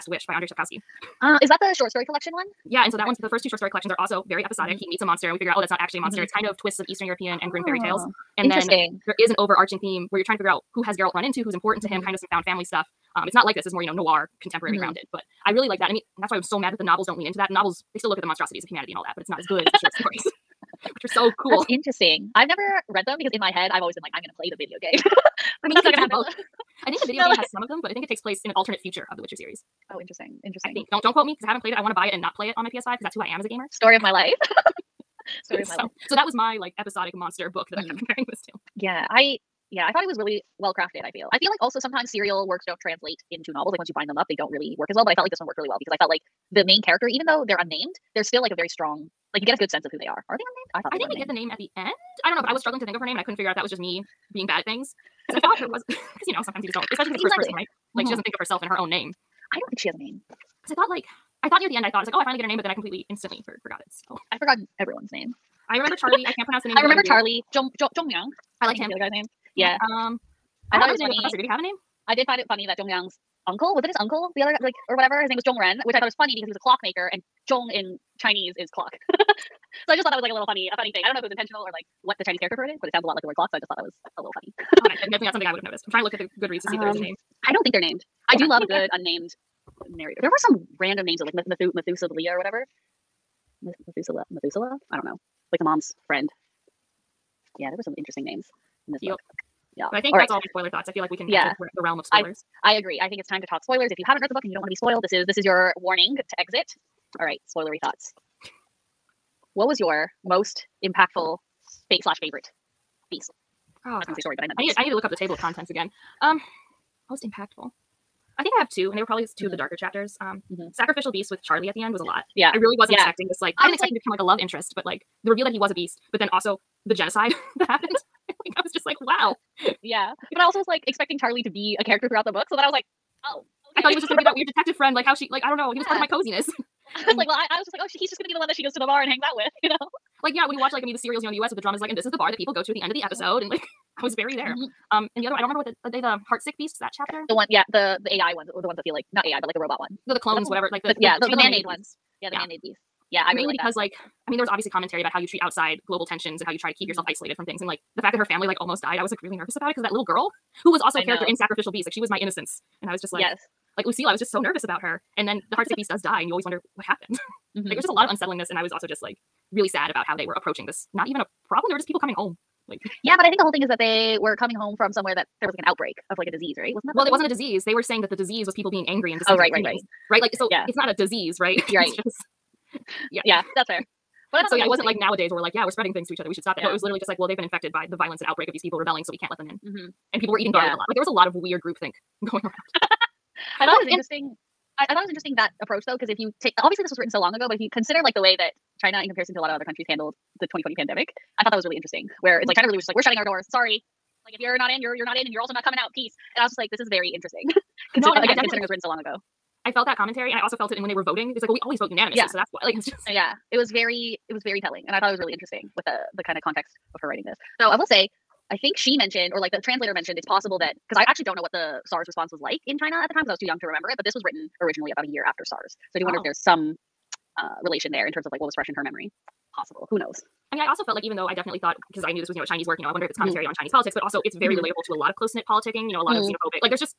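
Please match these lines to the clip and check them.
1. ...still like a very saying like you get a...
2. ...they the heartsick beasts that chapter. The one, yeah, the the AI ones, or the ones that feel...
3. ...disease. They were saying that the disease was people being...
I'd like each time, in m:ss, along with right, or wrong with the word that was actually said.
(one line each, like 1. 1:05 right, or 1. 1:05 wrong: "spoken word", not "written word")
1. 0:48 wrong: "strong", not "saying"
2. 2:25 right
3. 2:57 right.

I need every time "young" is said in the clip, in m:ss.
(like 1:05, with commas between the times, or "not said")
3:43.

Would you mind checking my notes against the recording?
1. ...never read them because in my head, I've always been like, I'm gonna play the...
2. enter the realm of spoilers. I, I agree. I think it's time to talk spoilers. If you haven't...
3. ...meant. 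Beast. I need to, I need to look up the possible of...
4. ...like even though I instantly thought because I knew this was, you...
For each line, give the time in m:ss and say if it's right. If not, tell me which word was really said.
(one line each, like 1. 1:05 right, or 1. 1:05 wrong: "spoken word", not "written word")
1. 0:22 right
2. 1:41 right
3. 1:54 wrong: "table", not "possible"
4. 3:50 wrong: "definitely", not "instantly".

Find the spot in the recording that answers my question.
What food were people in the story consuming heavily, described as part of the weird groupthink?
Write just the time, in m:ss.
3:10.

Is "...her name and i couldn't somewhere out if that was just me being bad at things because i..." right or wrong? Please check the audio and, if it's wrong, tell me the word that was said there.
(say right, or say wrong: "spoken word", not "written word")
wrong: "figure", not "somewhere".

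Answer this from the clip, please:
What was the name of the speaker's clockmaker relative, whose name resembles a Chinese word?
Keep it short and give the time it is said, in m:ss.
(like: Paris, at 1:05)
Jongren, at 1:15.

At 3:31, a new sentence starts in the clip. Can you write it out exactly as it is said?
It's like, well, we always vote unanimously, yeah.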